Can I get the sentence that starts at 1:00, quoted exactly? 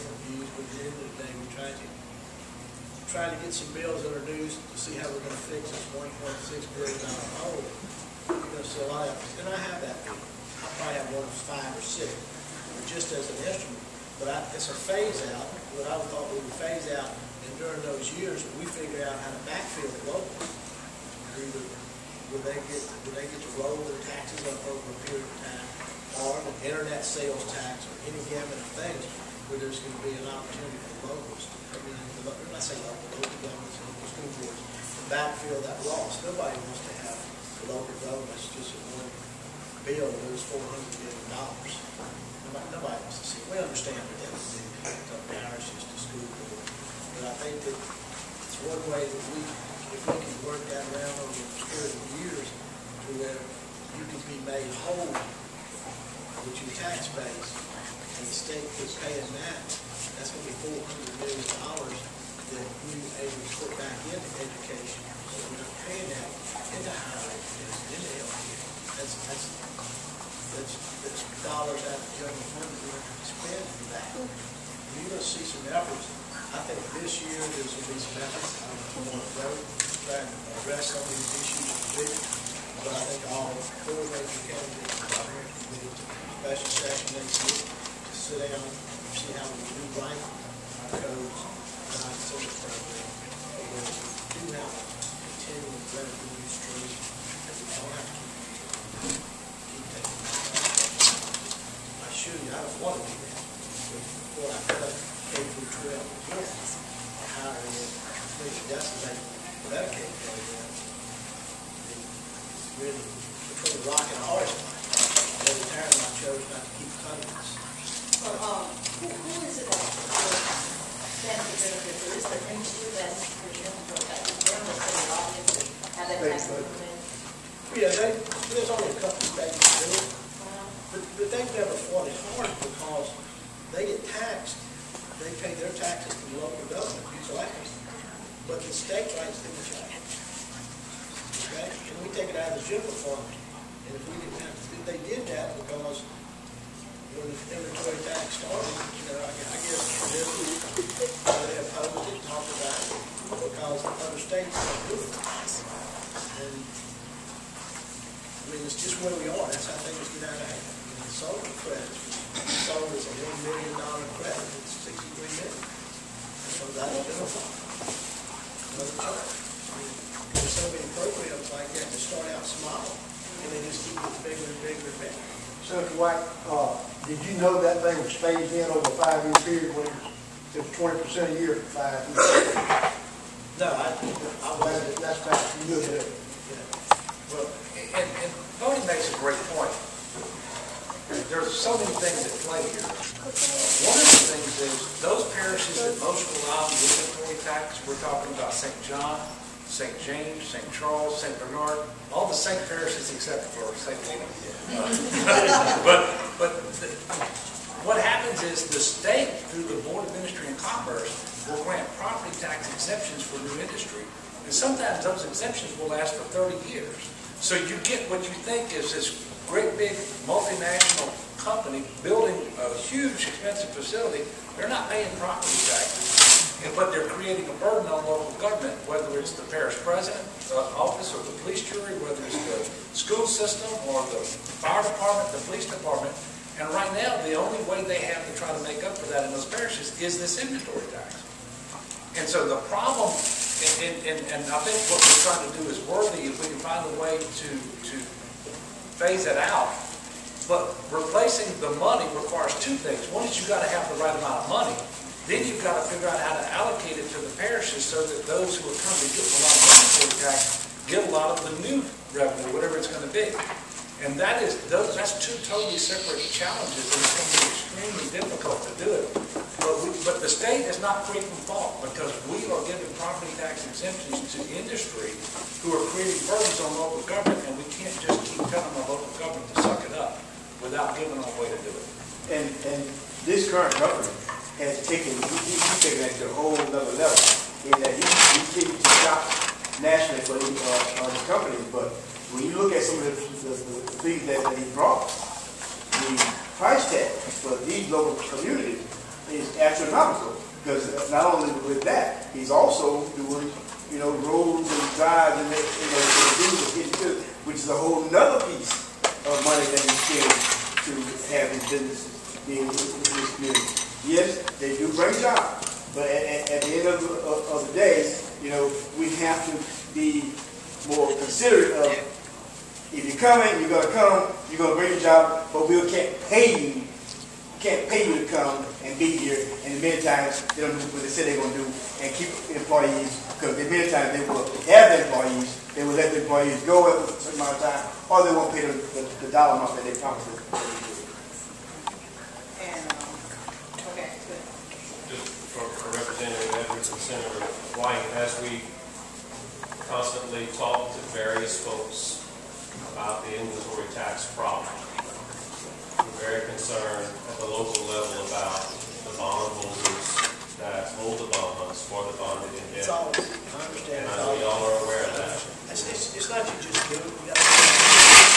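That's going to be $400 million that we able to put back into education.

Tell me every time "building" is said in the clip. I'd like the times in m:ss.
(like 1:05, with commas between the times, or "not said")
3:42.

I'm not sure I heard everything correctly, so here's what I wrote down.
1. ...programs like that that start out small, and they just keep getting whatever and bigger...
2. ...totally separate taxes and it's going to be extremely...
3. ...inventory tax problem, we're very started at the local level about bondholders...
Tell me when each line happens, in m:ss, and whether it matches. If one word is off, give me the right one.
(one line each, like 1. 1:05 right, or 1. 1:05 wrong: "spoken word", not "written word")
1. 2:50 wrong: "bigger", not "whatever"
2. 4:25 wrong: "challenges", not "taxes"
3. 5:53 wrong: "concerned", not "started".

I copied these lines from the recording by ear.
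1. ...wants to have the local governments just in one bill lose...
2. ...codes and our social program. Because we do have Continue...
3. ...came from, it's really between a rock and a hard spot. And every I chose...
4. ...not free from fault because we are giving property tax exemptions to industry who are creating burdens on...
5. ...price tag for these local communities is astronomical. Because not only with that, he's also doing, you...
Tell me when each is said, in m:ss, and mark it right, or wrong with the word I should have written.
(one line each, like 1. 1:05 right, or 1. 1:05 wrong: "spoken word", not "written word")
1. 0:36 right
2. 1:31 right
3. 1:49 right
4. 4:30 right
5. 4:56 right.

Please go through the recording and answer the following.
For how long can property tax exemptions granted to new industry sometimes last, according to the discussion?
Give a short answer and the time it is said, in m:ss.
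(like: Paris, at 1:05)
30 years, at 3:36.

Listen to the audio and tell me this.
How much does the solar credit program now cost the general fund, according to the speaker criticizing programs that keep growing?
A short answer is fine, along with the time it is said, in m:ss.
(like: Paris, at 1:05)
63 million, at 2:44.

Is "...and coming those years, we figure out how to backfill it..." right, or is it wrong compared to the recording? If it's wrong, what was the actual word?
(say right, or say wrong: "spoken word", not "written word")
wrong: "during", not "coming".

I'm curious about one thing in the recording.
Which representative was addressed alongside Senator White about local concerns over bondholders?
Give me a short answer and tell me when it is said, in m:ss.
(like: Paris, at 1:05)
Edwards, at 5:46.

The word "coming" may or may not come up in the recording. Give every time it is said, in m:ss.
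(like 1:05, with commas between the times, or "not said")
4:18, 5:23.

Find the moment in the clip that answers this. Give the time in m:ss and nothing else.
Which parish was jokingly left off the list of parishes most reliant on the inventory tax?
3:23.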